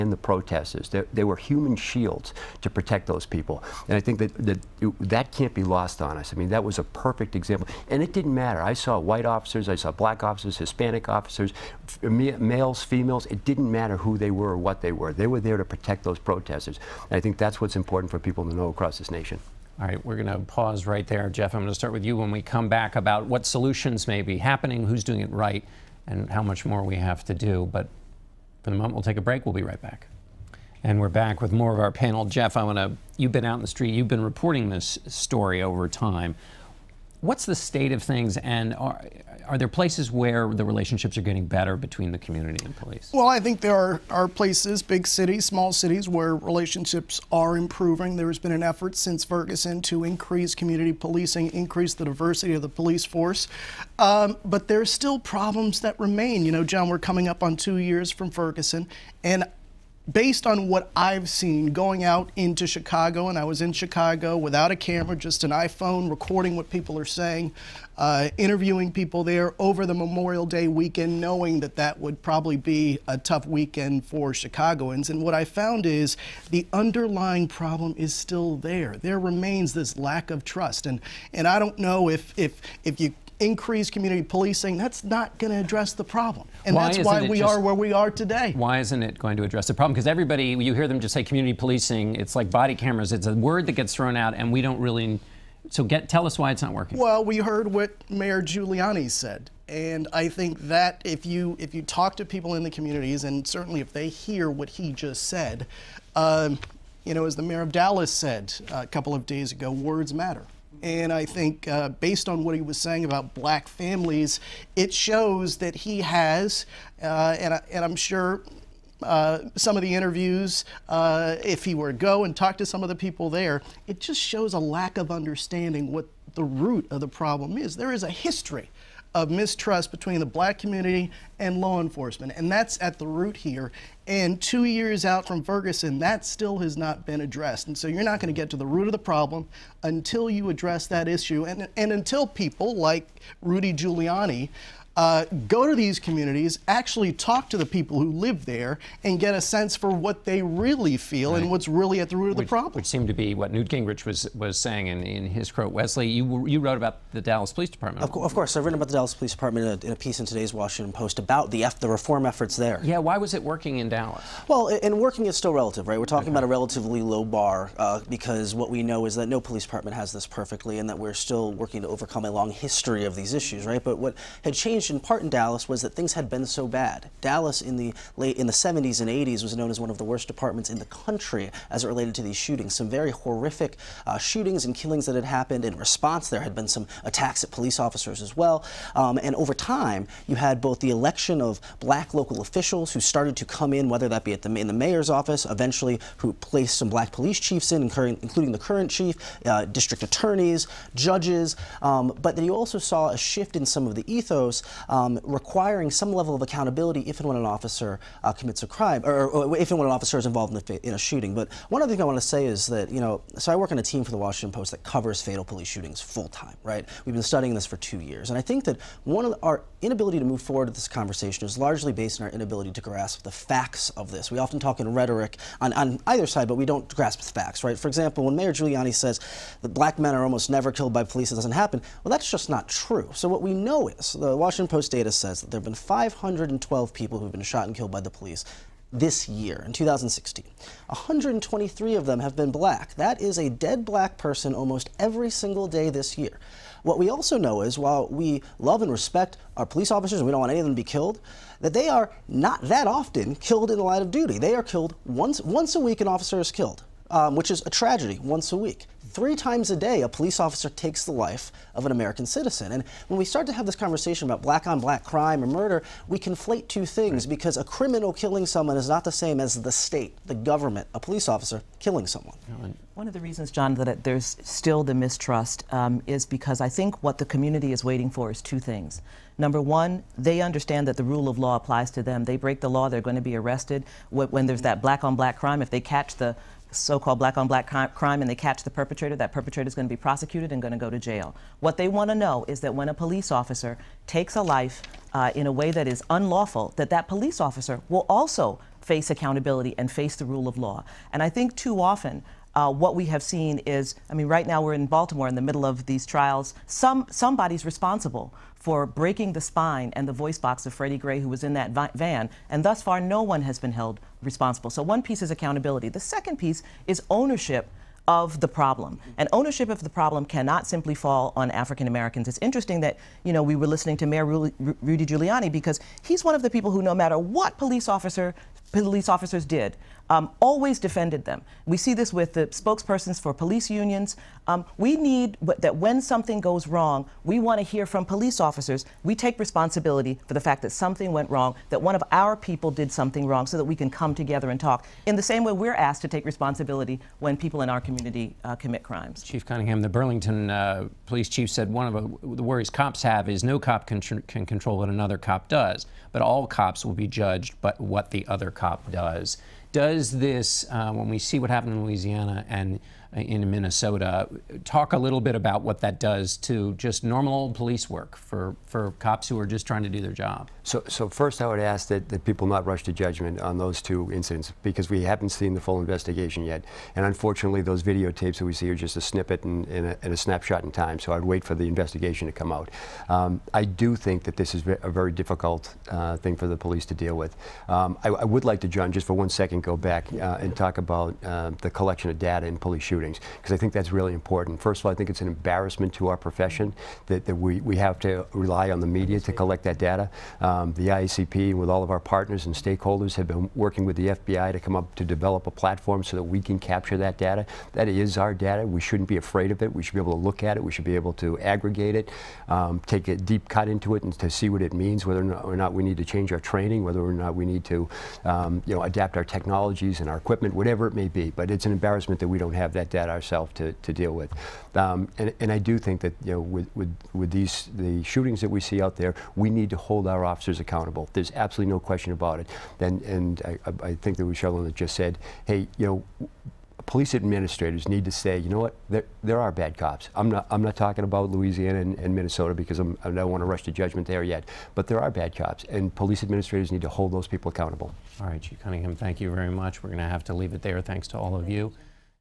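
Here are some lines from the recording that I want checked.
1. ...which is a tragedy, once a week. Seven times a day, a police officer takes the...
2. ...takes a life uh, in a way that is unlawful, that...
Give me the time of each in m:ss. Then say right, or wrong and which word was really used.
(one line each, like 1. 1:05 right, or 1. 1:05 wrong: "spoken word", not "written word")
1. 4:17 wrong: "Three", not "Seven"
2. 4:54 right.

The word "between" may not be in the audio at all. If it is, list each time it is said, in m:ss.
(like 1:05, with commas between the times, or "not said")
0:41, 2:09.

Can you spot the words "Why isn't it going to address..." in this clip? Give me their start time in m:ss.
1:28.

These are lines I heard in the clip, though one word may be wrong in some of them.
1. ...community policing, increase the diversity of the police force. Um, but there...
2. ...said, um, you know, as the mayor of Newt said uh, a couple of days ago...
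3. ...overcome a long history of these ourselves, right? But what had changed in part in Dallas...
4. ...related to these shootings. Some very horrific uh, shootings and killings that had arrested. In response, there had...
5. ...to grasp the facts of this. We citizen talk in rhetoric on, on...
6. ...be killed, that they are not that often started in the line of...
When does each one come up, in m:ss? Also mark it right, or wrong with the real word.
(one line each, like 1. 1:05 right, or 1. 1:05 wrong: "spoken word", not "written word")
1. 0:50 right
2. 1:45 wrong: "Dallas", not "Newt"
3. 2:51 wrong: "issues", not "ourselves"
4. 3:01 wrong: "happened", not "arrested"
5. 3:42 wrong: "often", not "citizen"
6. 4:10 wrong: "killed", not "started".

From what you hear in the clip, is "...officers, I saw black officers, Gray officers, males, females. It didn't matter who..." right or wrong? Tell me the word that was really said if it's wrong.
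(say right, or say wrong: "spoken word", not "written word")
wrong: "Hispanic", not "Gray".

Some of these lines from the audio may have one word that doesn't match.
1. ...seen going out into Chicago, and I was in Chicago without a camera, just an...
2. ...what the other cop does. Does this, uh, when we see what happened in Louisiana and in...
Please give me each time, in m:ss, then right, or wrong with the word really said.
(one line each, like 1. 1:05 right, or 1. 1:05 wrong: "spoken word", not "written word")
1. 1:01 right
2. 5:57 right.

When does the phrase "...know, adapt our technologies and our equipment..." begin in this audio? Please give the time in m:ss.
6:58.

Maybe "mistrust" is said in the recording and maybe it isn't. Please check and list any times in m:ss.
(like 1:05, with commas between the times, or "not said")
2:09, 4:34.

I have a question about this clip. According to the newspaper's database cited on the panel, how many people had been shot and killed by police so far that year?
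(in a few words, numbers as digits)
512.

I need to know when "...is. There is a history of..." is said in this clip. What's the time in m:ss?
2:07.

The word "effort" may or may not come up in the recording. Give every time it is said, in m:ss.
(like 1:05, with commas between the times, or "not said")
0:48, 2:42.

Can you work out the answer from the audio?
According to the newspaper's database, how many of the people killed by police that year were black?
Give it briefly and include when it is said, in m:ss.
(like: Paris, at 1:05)
123, at 4:00.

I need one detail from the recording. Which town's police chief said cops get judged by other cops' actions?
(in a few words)
Burlington.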